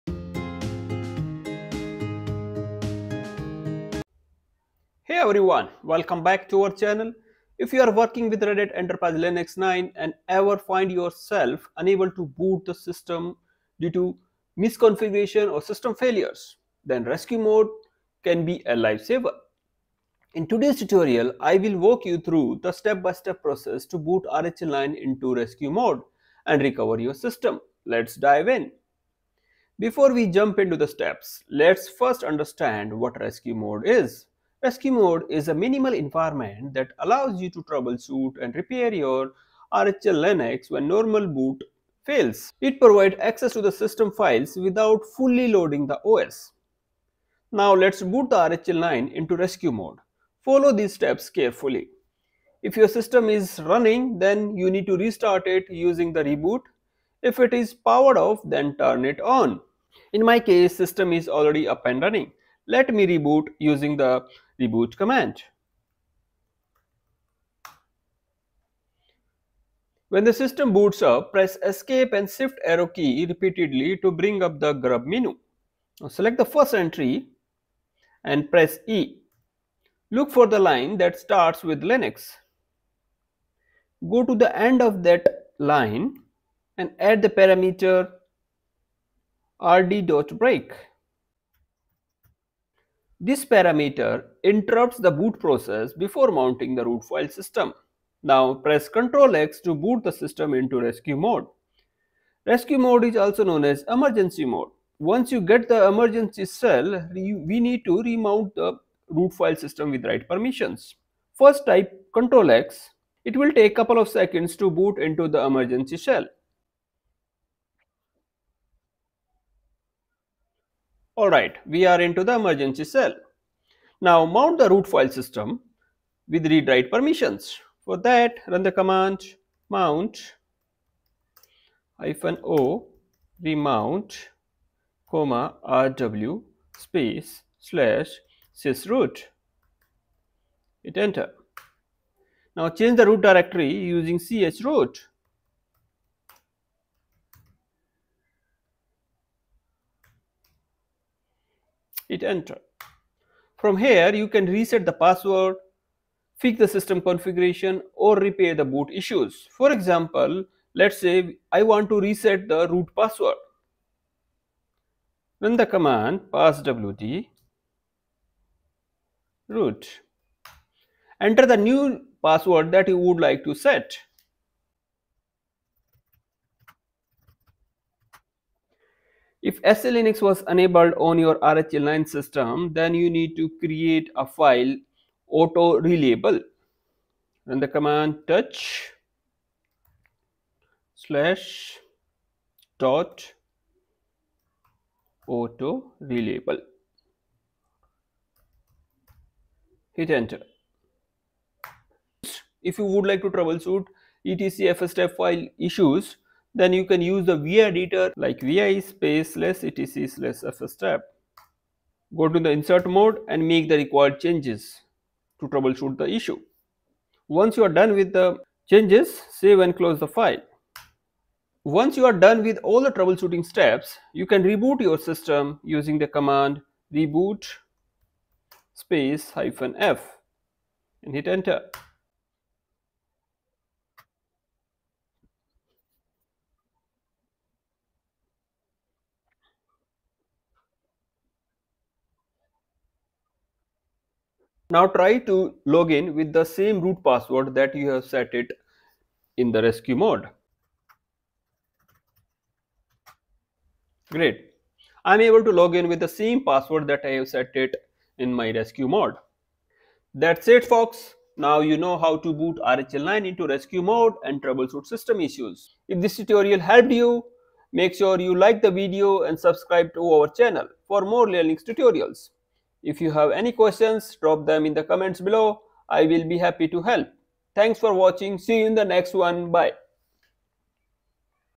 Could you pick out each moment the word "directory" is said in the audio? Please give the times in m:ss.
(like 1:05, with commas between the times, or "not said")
2:23.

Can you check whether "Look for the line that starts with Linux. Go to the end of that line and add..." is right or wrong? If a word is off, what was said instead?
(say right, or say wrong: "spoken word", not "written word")
right.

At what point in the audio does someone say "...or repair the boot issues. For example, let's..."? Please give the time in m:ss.
2:37.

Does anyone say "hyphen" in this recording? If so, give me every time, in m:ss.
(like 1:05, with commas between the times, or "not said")
2:11, 3:49.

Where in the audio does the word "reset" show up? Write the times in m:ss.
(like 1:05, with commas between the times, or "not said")
2:34, 2:42.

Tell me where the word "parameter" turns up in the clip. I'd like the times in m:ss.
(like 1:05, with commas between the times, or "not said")
1:27, 1:33.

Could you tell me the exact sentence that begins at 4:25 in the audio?
If this tutorial helped you, make sure you like the video and subscribe to our channel for more Linux tutorials.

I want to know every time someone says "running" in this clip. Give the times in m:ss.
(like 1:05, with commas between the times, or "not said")
0:53, 1:01.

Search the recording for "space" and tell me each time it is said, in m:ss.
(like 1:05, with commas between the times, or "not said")
2:16, 3:28, 3:48.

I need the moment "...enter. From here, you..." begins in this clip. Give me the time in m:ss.
2:32.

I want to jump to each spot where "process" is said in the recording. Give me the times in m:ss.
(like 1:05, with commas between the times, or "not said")
0:23, 1:35.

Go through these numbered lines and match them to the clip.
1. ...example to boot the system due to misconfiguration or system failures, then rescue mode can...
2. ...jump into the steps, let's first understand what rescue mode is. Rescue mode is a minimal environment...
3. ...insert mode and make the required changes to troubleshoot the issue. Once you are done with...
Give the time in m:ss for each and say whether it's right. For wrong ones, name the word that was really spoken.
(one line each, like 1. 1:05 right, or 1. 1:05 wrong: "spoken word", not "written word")
1. 0:11 wrong: "unable", not "example"
2. 0:30 right
3. 3:32 right.